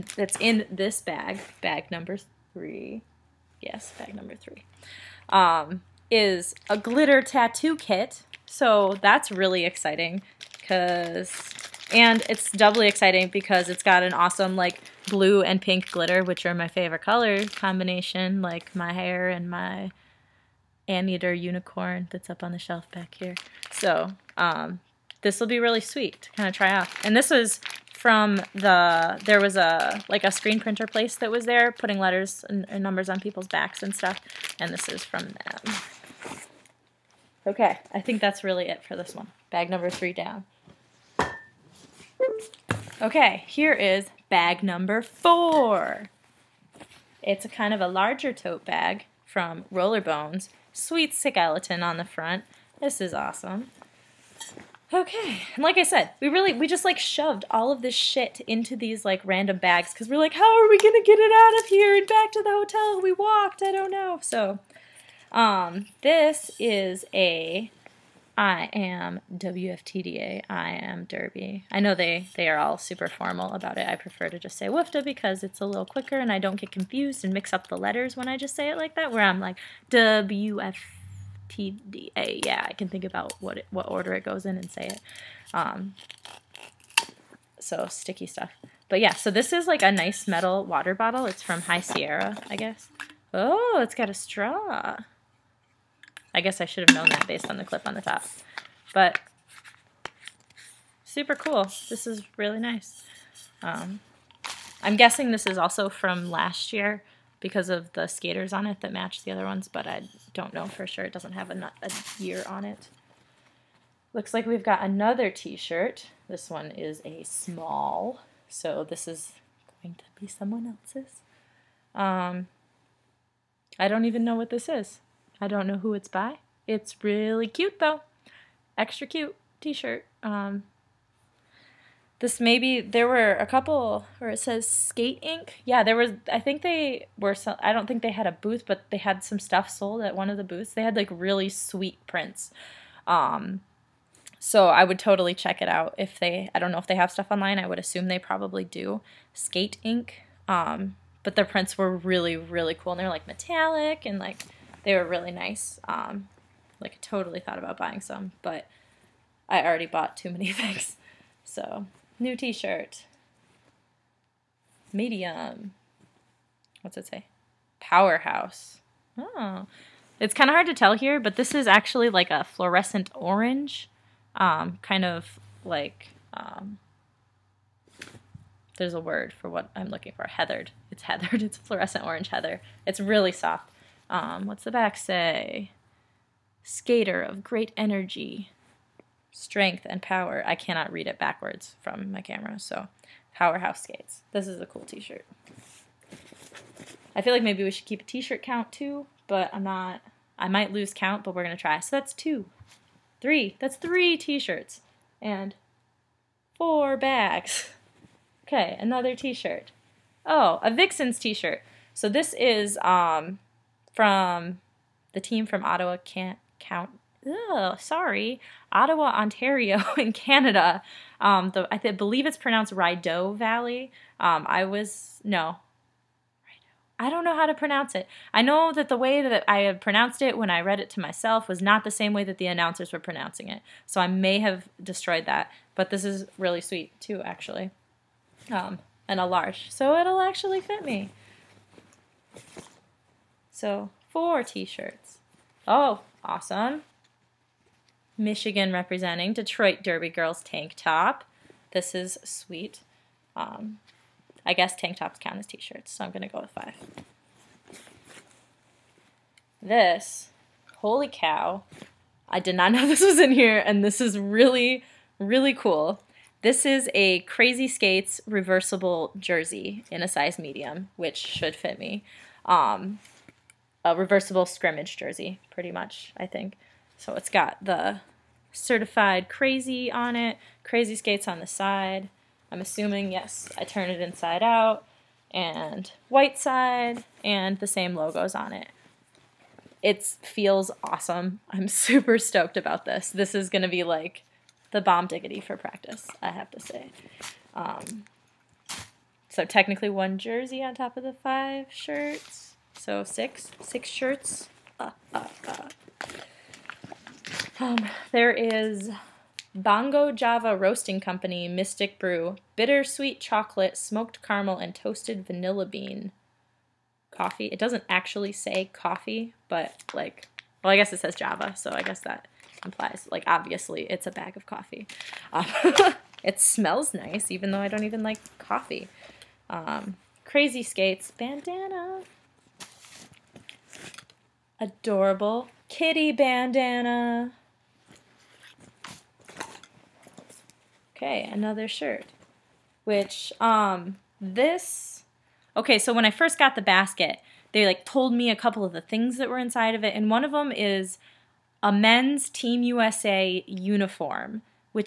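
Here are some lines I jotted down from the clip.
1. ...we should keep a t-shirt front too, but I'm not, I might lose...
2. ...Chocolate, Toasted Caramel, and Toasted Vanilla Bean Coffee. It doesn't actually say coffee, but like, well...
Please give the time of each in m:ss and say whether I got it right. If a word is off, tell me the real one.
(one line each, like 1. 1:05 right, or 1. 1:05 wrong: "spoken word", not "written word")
1. 3:17 wrong: "count", not "front"
2. 5:13 wrong: "Smoked", not "Toasted".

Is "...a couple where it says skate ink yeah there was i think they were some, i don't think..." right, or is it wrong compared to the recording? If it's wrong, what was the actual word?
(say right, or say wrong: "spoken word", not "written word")
right.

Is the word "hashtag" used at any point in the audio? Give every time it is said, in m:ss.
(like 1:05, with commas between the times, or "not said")
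not said.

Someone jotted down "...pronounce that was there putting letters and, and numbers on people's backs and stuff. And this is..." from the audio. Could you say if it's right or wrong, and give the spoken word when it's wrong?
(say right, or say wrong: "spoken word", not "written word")
wrong: "place", not "pronounce".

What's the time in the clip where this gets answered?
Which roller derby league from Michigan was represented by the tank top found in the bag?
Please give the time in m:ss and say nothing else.
4:09.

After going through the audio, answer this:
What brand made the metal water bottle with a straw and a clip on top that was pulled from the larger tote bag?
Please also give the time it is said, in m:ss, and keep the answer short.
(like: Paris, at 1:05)
High Sierra, at 1:31.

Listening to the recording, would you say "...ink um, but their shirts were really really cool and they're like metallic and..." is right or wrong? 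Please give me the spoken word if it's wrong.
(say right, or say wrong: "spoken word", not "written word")
wrong: "prints", not "shirts".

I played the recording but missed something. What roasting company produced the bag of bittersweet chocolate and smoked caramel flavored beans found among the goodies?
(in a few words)
Bongo Java Roasting Company.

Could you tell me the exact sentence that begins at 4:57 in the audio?
Um, so technically one jersey on top of the five shirts.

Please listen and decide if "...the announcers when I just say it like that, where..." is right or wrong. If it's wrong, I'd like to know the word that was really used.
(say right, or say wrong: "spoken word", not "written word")
wrong: "letters", not "announcers".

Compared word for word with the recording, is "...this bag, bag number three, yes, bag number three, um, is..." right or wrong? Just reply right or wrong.
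right.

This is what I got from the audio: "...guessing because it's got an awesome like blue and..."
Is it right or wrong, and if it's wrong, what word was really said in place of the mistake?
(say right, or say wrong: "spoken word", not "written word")
wrong: "exciting", not "guessing".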